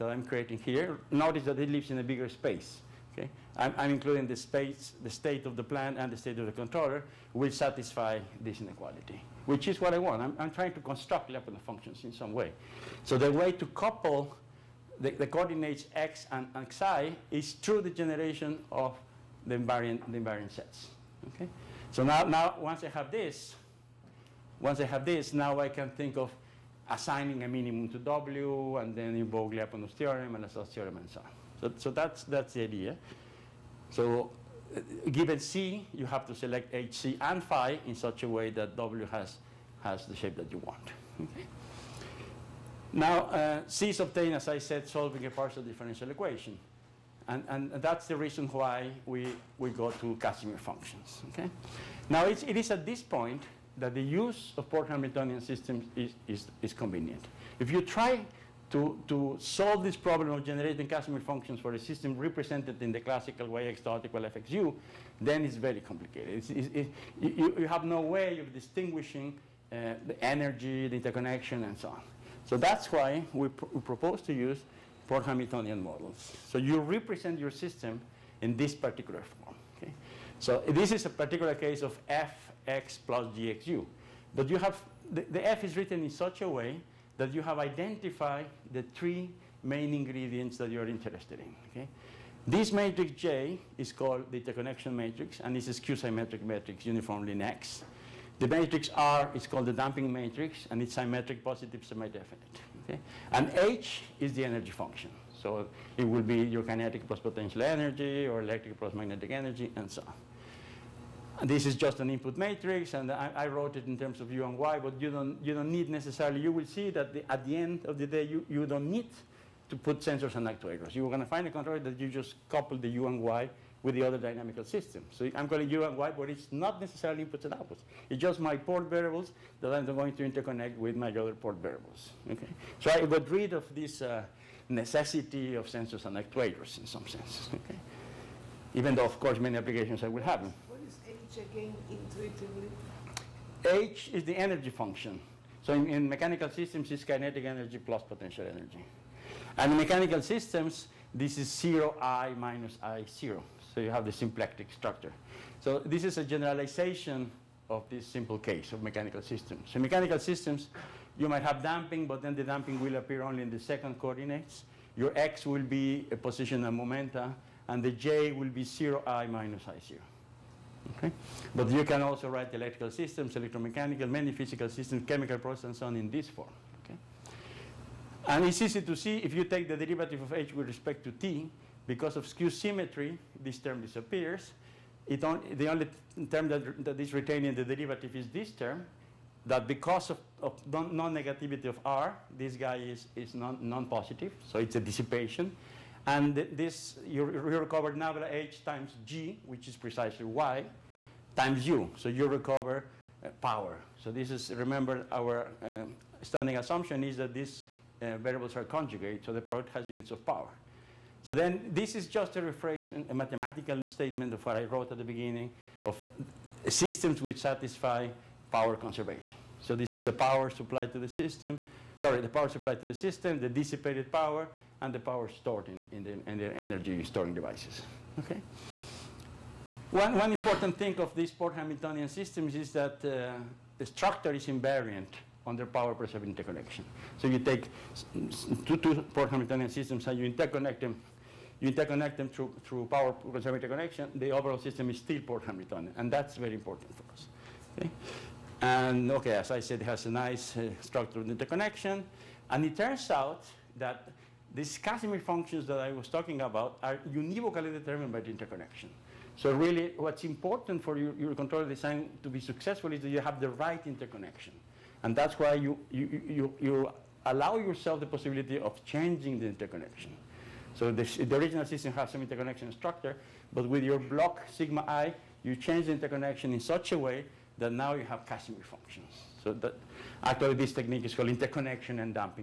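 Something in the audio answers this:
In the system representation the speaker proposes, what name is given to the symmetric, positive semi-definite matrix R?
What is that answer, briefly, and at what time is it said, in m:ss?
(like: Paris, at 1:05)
damping matrix, at 1:39.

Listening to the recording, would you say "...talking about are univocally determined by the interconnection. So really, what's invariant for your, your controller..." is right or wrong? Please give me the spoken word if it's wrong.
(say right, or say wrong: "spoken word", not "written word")
wrong: "important", not "invariant".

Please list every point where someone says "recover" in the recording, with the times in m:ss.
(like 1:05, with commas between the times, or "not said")
3:17, 3:22.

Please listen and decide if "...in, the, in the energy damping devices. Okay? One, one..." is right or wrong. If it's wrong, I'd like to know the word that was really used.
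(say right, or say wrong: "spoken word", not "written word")
wrong: "storing", not "damping".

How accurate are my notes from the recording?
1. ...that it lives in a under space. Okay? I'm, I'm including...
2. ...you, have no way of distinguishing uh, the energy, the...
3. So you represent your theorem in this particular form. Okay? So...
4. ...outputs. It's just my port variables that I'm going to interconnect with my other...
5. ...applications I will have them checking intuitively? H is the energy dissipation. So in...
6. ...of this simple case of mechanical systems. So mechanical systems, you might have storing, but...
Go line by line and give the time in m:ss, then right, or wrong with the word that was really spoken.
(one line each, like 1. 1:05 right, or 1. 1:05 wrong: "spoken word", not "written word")
1. 0:01 wrong: "bigger", not "under"
2. 1:07 right
3. 1:16 wrong: "system", not "theorem"
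4. 2:07 right
5. 2:19 wrong: "function", not "dissipation"
6. 2:37 wrong: "damping", not "storing".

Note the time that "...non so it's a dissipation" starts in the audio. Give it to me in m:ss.
3:14.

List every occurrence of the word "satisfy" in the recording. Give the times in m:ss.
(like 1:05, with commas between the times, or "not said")
0:07, 3:37.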